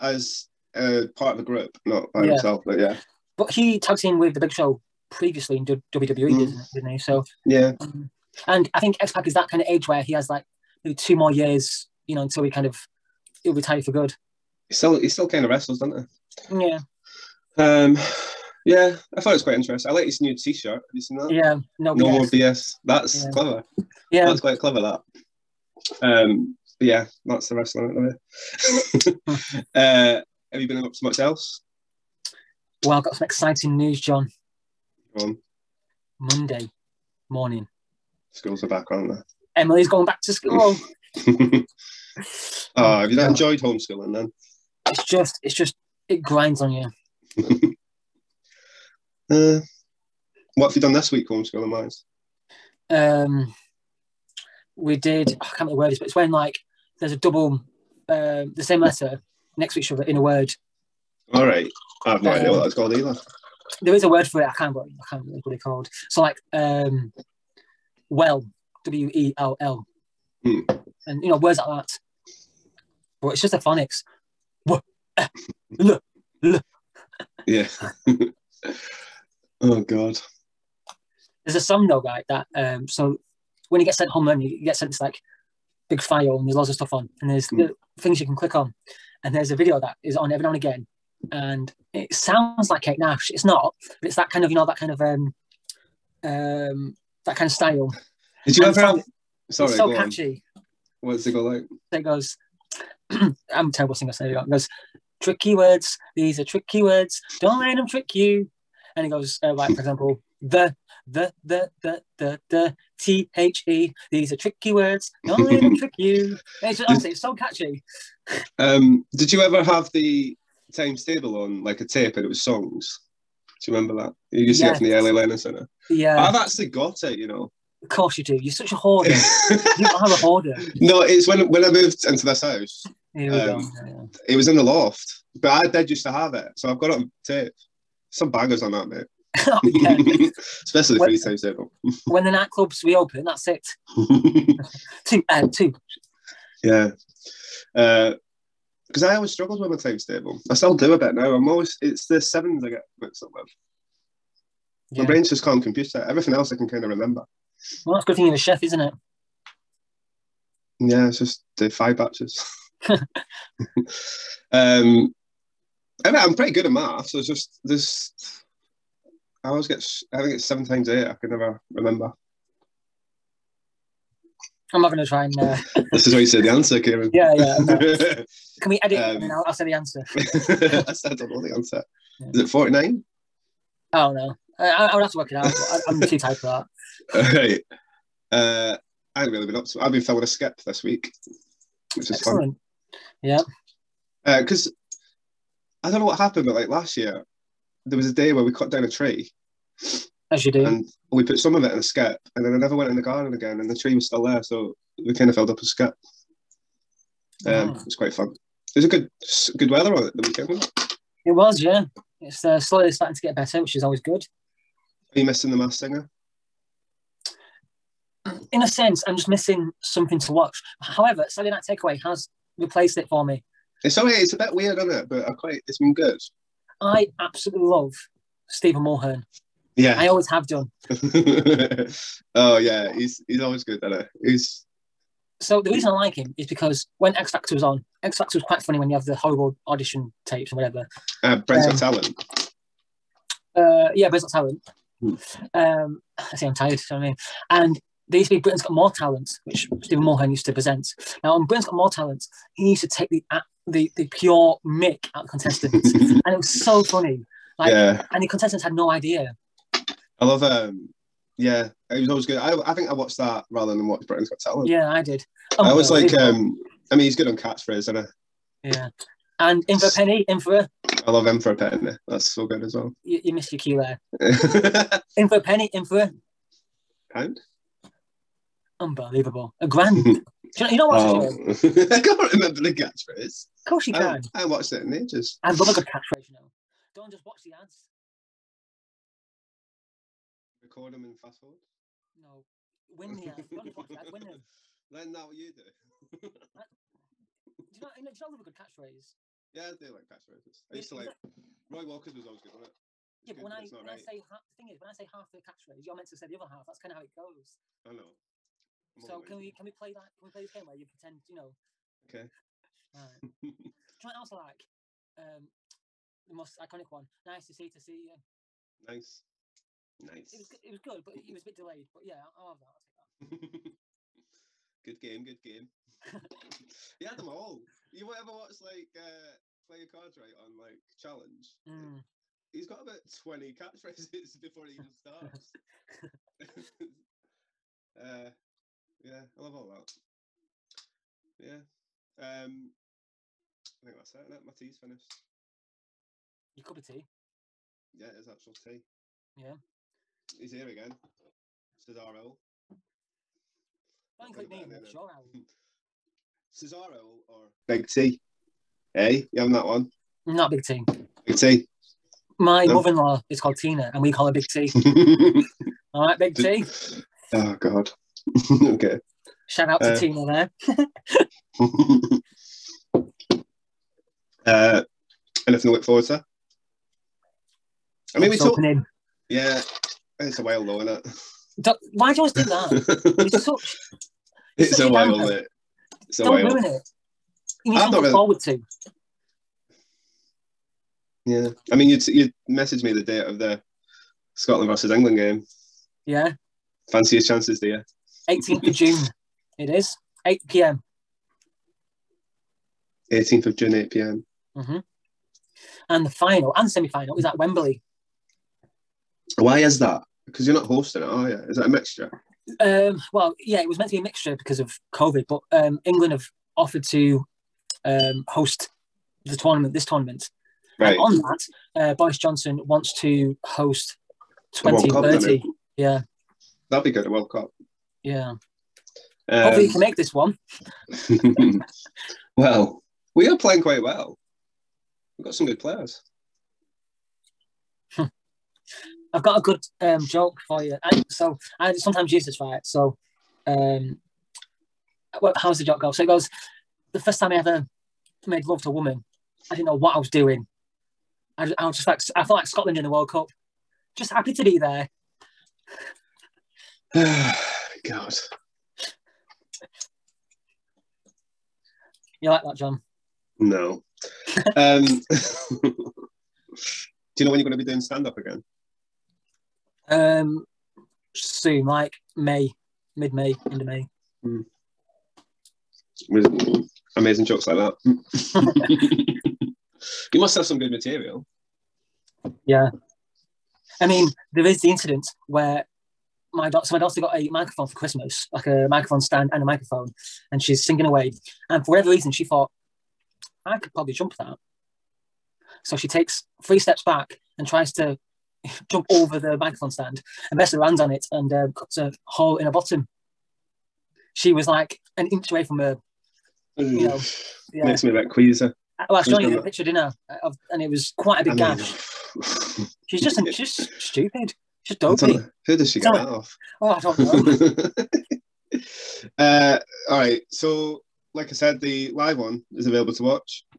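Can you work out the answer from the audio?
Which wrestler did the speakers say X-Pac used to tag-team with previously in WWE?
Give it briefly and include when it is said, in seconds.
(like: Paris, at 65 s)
Big Show, at 4 s.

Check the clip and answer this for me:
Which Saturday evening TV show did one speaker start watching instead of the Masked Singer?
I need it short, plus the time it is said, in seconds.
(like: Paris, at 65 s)
Saturday Night Takeaway, at 221 s.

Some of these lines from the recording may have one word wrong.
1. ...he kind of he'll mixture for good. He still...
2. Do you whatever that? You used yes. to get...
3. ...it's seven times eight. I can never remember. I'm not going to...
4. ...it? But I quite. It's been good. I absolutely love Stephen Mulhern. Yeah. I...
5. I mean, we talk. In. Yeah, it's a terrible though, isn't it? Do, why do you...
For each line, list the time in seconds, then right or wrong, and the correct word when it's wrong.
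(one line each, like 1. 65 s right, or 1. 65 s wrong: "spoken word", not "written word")
1. 12 s wrong: "retire", not "mixture"
2. 123 s wrong: "remember", not "whatever"
3. 170 s right
4. 224 s right
5. 378 s wrong: "while", not "terrible".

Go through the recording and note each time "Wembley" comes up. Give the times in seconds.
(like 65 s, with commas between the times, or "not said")
407 s.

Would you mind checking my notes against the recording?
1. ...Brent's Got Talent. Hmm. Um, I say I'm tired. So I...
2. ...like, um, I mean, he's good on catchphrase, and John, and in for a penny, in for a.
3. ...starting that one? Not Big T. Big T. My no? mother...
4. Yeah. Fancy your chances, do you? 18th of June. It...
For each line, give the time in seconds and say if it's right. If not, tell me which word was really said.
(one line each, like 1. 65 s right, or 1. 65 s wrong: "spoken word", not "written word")
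1. 244 s right
2. 266 s wrong: "Yeah", not "John"
3. 359 s wrong: "having", not "starting"
4. 396 s right.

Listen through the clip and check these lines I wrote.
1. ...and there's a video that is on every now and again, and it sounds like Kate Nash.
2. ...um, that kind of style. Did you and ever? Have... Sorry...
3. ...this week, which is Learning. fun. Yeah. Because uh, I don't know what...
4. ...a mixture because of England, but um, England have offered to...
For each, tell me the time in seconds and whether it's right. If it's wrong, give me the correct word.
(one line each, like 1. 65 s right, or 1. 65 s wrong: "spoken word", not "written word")
1. 89 s right
2. 96 s right
3. 190 s wrong: "Excellent", not "Learning"
4. 413 s wrong: "COVID", not "England".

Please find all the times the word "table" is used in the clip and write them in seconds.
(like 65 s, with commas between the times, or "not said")
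121 s, 141 s, 150 s.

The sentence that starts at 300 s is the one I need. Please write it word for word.
I used to like Roy Walker's was always good, wasn't it?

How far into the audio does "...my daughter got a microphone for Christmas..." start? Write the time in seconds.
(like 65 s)
486 s.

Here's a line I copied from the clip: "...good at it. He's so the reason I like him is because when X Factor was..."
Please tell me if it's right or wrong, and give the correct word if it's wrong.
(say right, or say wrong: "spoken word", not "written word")
right.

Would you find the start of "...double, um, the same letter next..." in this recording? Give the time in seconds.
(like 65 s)
57 s.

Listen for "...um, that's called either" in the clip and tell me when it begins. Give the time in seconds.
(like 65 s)
62 s.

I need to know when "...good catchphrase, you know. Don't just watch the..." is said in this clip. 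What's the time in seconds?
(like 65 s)
285 s.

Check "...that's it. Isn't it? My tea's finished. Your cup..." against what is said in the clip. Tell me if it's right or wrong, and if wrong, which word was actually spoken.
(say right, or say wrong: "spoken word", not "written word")
right.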